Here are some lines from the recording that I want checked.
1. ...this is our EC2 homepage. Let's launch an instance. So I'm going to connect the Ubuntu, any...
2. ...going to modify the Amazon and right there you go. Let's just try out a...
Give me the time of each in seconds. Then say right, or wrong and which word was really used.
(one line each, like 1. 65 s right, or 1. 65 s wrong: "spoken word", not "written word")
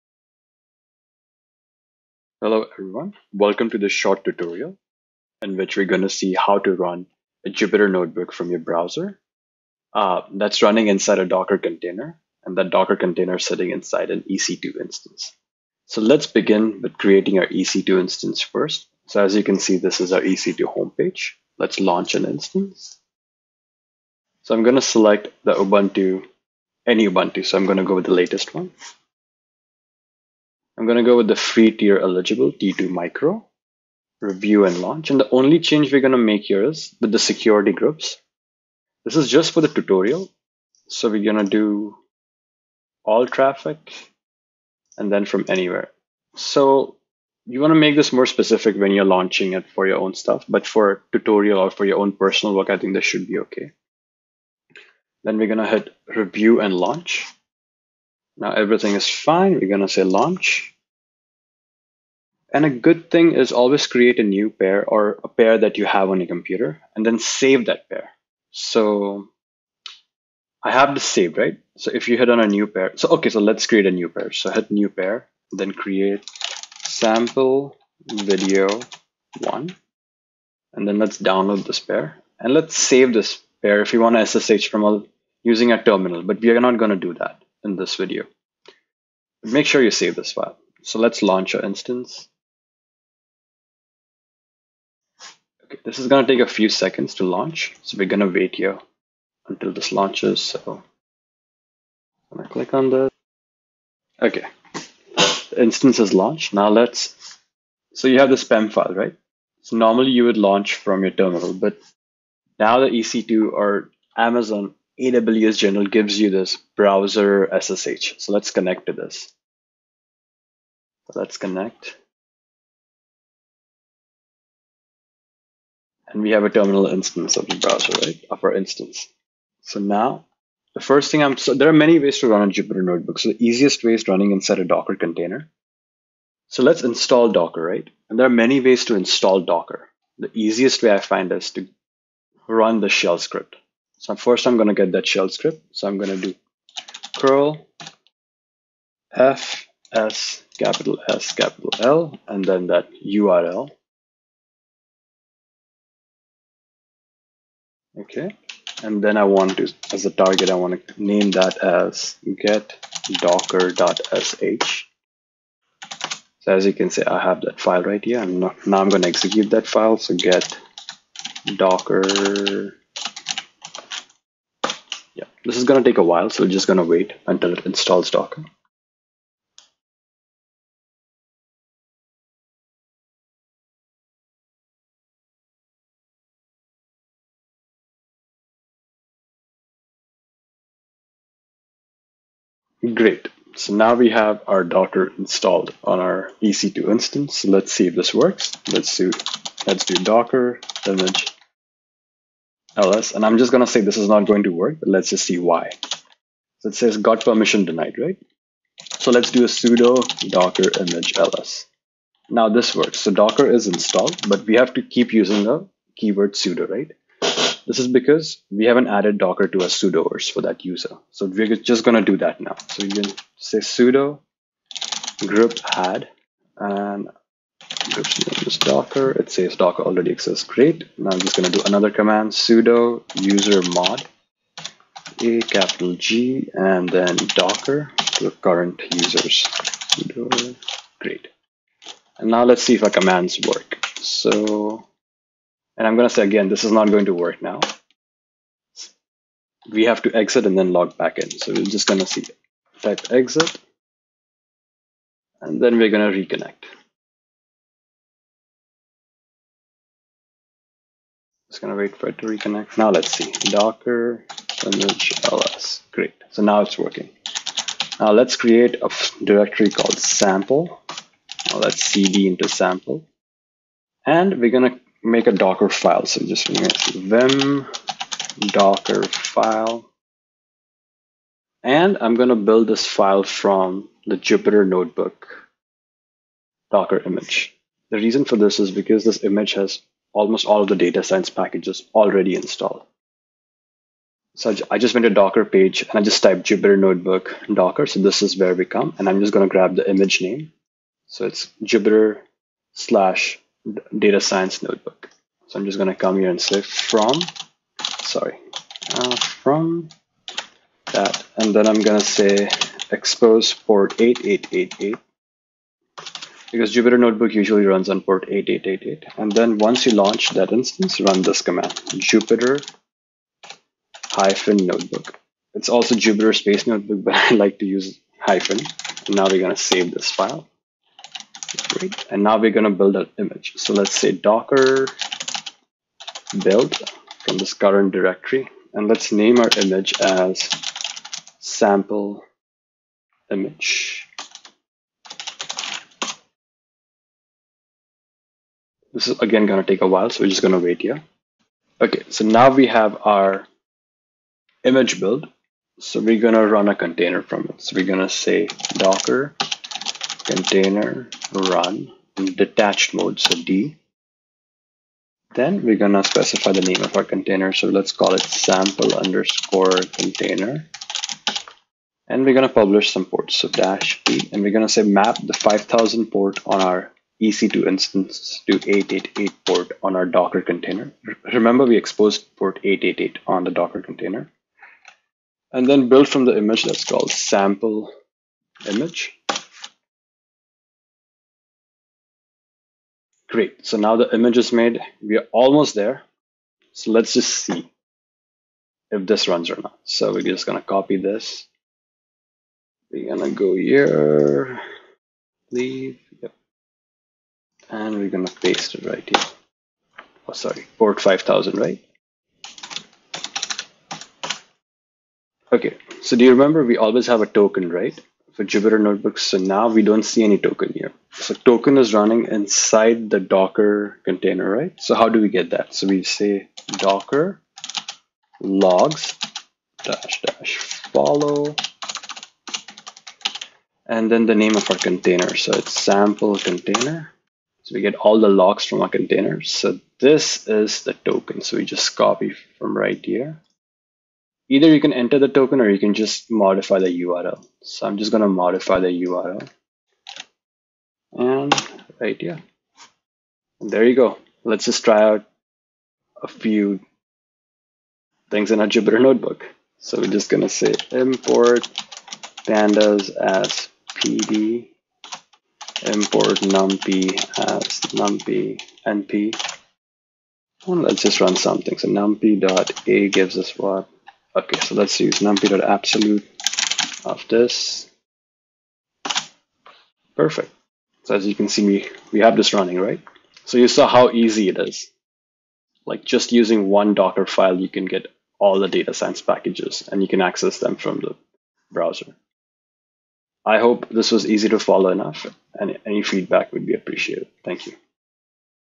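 1. 19 s wrong: "select", not "connect"
2. 448 s wrong: "URL", not "Amazon".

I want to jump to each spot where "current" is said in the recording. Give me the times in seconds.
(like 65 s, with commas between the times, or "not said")
238 s, 337 s.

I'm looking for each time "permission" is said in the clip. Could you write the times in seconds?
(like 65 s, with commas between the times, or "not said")
207 s.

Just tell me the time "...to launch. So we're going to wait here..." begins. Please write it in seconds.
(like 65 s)
97 s.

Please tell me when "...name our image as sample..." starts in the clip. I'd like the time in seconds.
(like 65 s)
339 s.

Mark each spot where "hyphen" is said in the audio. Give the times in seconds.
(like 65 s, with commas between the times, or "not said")
324 s, 328 s.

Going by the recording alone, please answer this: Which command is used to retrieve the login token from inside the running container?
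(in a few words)
docker logs.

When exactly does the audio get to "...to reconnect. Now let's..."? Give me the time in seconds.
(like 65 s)
262 s.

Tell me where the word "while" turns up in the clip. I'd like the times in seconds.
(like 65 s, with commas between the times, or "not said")
176 s, 349 s.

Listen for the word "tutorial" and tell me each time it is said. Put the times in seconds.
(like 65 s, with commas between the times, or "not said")
4 s, 39 s, 51 s.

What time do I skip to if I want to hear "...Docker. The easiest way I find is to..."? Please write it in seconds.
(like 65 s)
139 s.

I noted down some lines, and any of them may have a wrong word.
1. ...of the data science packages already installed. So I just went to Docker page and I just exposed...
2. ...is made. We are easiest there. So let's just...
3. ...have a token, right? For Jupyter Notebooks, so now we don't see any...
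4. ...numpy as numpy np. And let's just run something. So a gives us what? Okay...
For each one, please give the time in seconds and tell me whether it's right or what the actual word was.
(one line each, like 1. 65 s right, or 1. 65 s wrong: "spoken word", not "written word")
1. 290 s wrong: "typed", not "exposed"
2. 394 s wrong: "almost", not "easiest"
3. 417 s right
4. 466 s right.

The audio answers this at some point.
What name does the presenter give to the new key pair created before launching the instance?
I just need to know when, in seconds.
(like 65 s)
76 s.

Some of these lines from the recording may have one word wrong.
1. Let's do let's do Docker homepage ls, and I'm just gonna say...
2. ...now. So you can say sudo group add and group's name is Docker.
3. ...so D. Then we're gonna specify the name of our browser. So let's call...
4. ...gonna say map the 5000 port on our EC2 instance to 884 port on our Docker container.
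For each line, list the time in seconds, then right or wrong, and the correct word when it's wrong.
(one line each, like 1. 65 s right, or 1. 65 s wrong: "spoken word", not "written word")
1. 198 s wrong: "image", not "homepage"
2. 222 s right
3. 363 s wrong: "container", not "browser"
4. 374 s wrong: "888", not "884".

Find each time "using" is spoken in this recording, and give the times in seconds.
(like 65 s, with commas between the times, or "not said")
85 s, 215 s, 486 s.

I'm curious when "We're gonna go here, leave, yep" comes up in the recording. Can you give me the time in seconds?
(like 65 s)
402 s.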